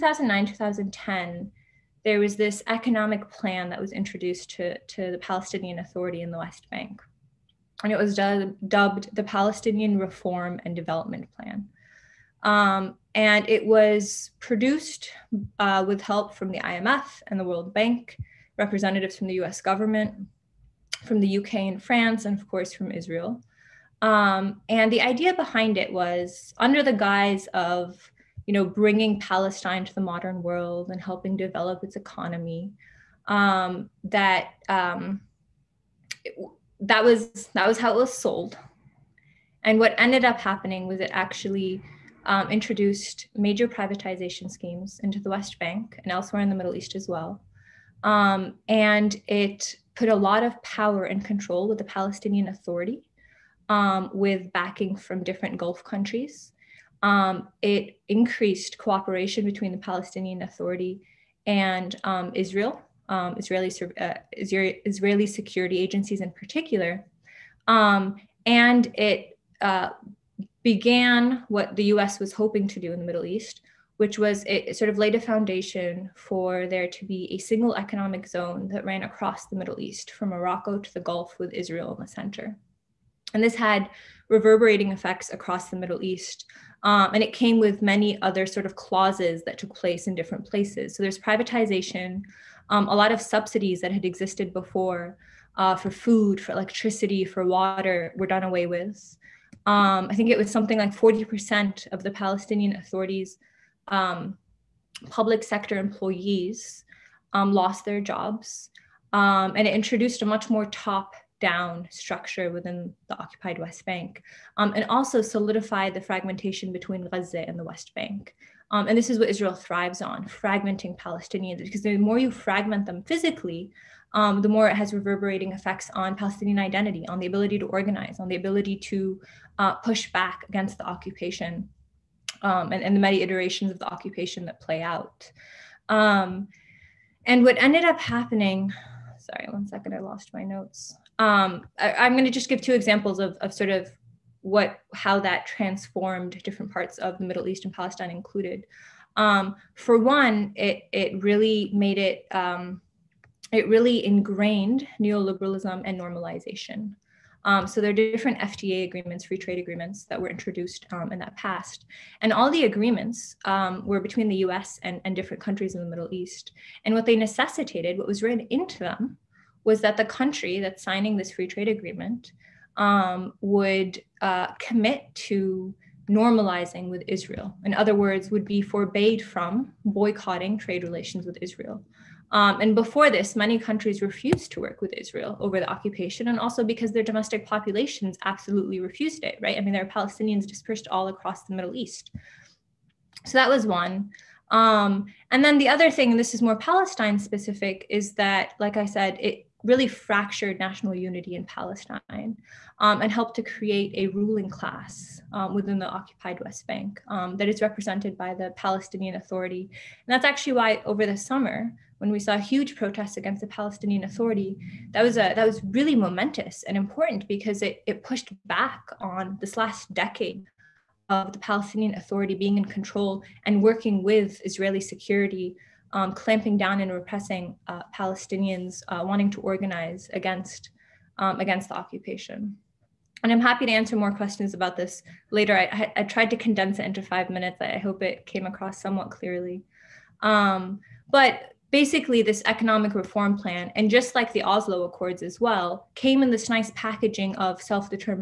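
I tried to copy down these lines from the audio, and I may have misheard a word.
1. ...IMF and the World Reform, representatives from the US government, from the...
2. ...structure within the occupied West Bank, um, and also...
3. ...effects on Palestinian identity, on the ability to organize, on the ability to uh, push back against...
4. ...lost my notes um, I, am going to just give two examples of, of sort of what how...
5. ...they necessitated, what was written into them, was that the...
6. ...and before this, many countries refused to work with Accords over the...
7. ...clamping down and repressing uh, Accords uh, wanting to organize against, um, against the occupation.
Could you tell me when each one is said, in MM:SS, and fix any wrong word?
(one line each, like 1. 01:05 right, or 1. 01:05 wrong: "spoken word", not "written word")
1. 00:16 wrong: "Bank", not "Reform"
2. 01:51 right
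3. 02:05 right
4. 02:19 right
5. 02:47 right
6. 03:02 wrong: "Israel", not "Accords"
7. 03:46 wrong: "Palestinians", not "Accords".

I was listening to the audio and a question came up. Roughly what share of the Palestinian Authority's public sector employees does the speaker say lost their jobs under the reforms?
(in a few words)
40%.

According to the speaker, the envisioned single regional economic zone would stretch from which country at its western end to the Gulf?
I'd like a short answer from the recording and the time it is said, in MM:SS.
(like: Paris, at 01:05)
Morocco, at 01:20.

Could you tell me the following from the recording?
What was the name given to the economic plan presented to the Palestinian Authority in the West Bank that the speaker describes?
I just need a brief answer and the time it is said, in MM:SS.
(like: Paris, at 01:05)
Palestinian Reform and Development Plan, at 00:09.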